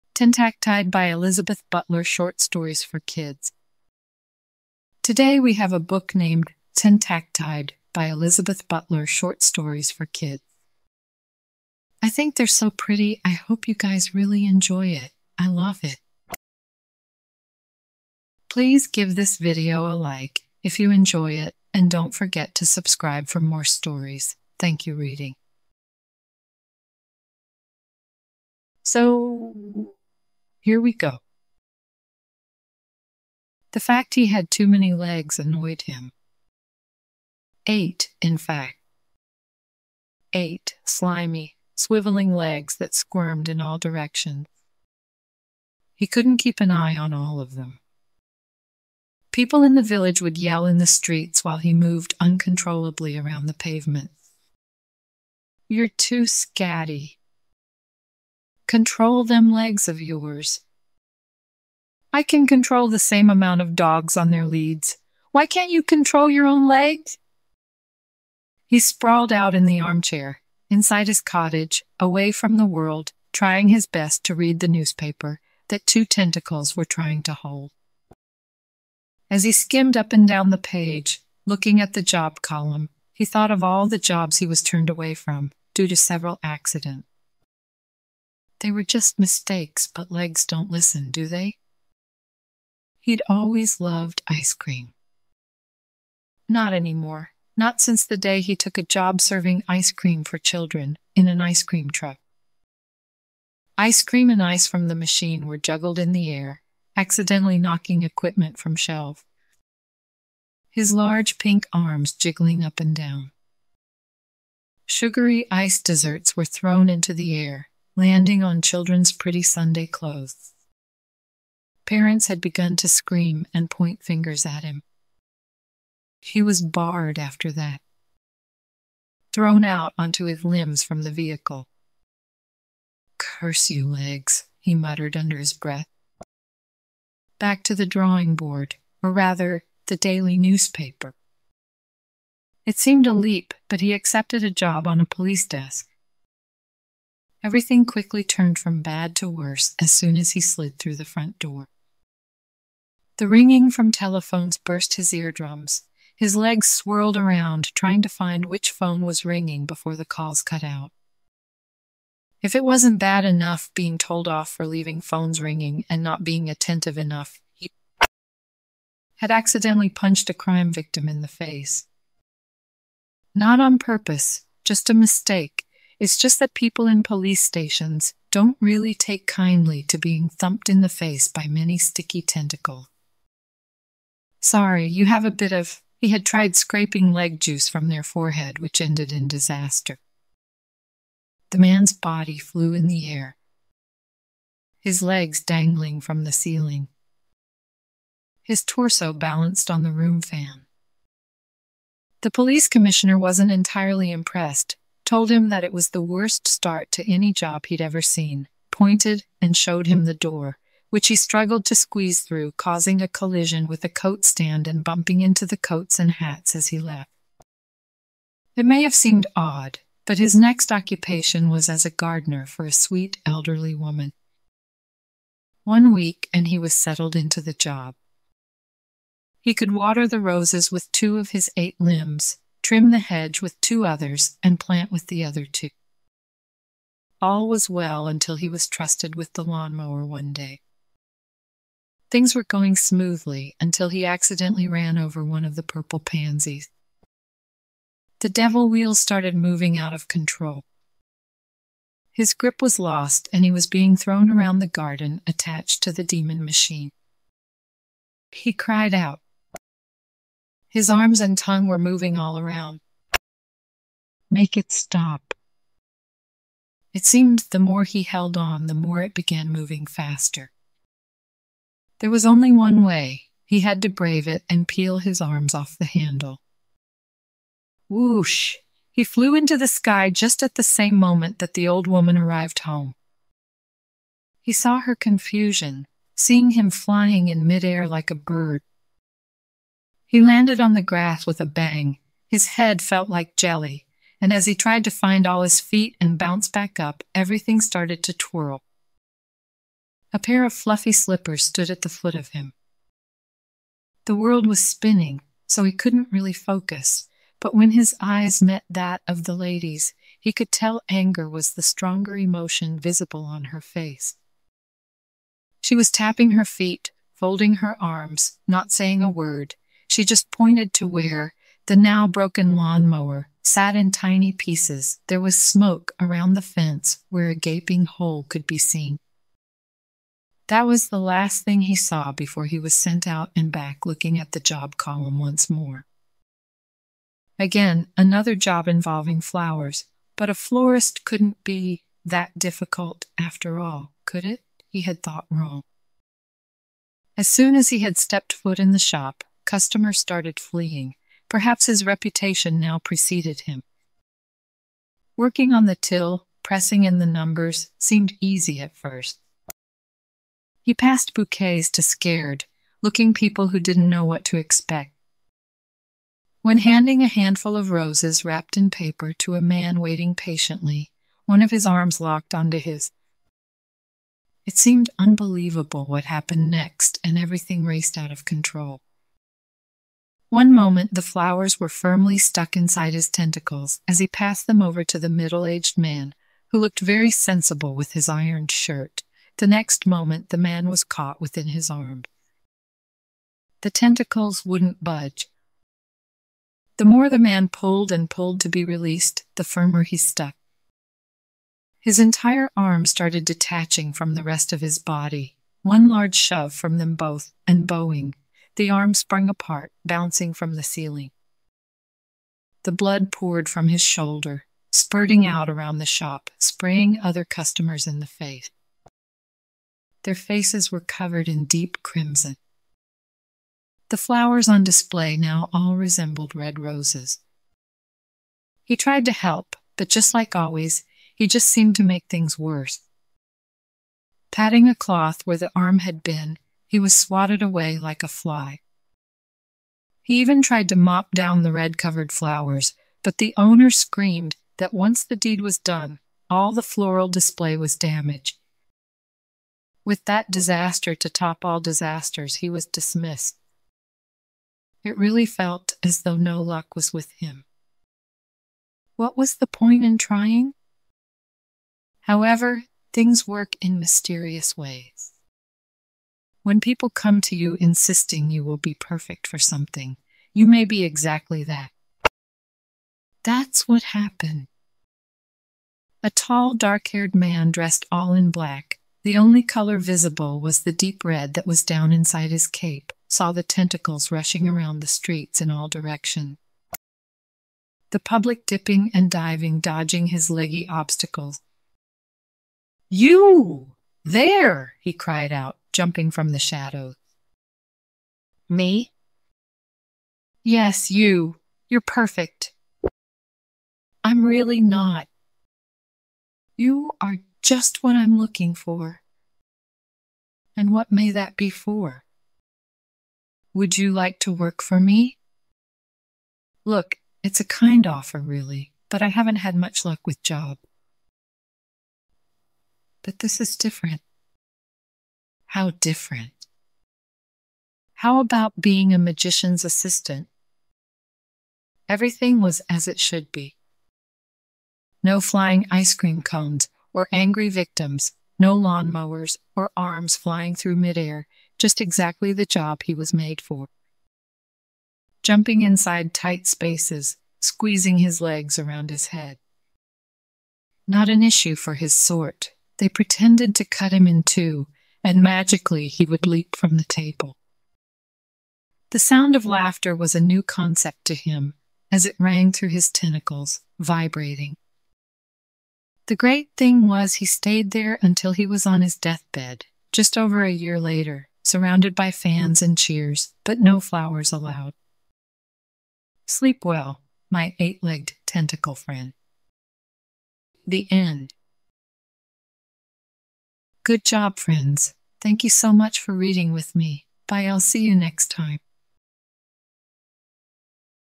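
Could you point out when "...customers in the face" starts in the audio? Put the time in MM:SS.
06:57.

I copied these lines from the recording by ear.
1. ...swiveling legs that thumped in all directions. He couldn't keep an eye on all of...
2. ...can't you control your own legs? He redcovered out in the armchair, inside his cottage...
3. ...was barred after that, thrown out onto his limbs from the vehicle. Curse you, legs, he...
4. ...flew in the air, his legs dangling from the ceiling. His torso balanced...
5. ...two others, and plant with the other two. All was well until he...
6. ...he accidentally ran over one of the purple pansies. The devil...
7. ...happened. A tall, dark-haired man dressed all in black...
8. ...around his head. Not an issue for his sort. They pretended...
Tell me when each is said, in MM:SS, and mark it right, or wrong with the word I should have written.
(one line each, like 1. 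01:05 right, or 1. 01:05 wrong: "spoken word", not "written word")
1. 00:41 wrong: "squirmed", not "thumped"
2. 01:05 wrong: "sprawled", not "redcovered"
3. 02:06 right
4. 03:12 right
5. 03:53 right
6. 04:03 right
7. 07:53 right
8. 09:08 right.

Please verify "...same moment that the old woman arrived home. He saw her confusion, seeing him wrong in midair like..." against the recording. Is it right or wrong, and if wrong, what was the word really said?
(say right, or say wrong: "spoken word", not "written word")
wrong: "flying", not "wrong".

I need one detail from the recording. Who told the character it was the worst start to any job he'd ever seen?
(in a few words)
The police commissioner.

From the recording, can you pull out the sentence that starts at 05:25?
There was smoke around the fence where a gaping hole could be seen.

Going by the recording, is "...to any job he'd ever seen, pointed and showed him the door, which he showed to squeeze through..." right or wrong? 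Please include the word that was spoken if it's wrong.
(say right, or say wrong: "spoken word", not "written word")
wrong: "struggled", not "showed".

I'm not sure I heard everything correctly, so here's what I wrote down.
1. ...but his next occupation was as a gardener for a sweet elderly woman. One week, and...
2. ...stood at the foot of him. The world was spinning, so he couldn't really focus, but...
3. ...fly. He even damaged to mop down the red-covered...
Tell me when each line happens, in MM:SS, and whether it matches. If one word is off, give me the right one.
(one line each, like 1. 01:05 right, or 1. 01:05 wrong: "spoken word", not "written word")
1. 03:40 right
2. 05:01 right
3. 07:18 wrong: "tried", not "damaged".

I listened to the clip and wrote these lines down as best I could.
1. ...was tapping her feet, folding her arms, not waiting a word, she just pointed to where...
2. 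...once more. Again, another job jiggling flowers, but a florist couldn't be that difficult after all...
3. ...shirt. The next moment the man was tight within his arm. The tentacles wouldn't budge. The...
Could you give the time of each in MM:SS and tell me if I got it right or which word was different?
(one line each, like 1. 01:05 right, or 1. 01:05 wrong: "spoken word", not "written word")
1. 05:15 wrong: "saying", not "waiting"
2. 05:35 wrong: "involving", not "jiggling"
3. 06:28 wrong: "caught", not "tight".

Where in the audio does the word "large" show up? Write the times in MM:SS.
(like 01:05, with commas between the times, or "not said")
01:50, 06:45.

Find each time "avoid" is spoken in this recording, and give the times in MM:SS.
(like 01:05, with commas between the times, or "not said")
not said.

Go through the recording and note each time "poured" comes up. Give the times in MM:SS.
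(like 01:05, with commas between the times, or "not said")
06:53.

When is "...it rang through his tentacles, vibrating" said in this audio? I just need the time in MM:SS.
09:22.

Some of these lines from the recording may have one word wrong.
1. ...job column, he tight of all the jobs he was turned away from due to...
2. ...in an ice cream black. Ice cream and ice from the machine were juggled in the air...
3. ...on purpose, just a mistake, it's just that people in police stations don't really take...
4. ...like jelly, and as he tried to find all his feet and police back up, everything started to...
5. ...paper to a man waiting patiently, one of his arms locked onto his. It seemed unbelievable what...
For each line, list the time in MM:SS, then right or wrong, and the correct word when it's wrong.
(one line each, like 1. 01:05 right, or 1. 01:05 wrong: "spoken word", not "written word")
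1. 01:22 wrong: "thought", not "tight"
2. 01:41 wrong: "truck", not "black"
3. 02:53 right
4. 04:53 wrong: "bounce", not "police"
5. 06:08 right.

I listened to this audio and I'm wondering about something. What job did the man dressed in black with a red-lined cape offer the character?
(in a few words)
Magician's assistant.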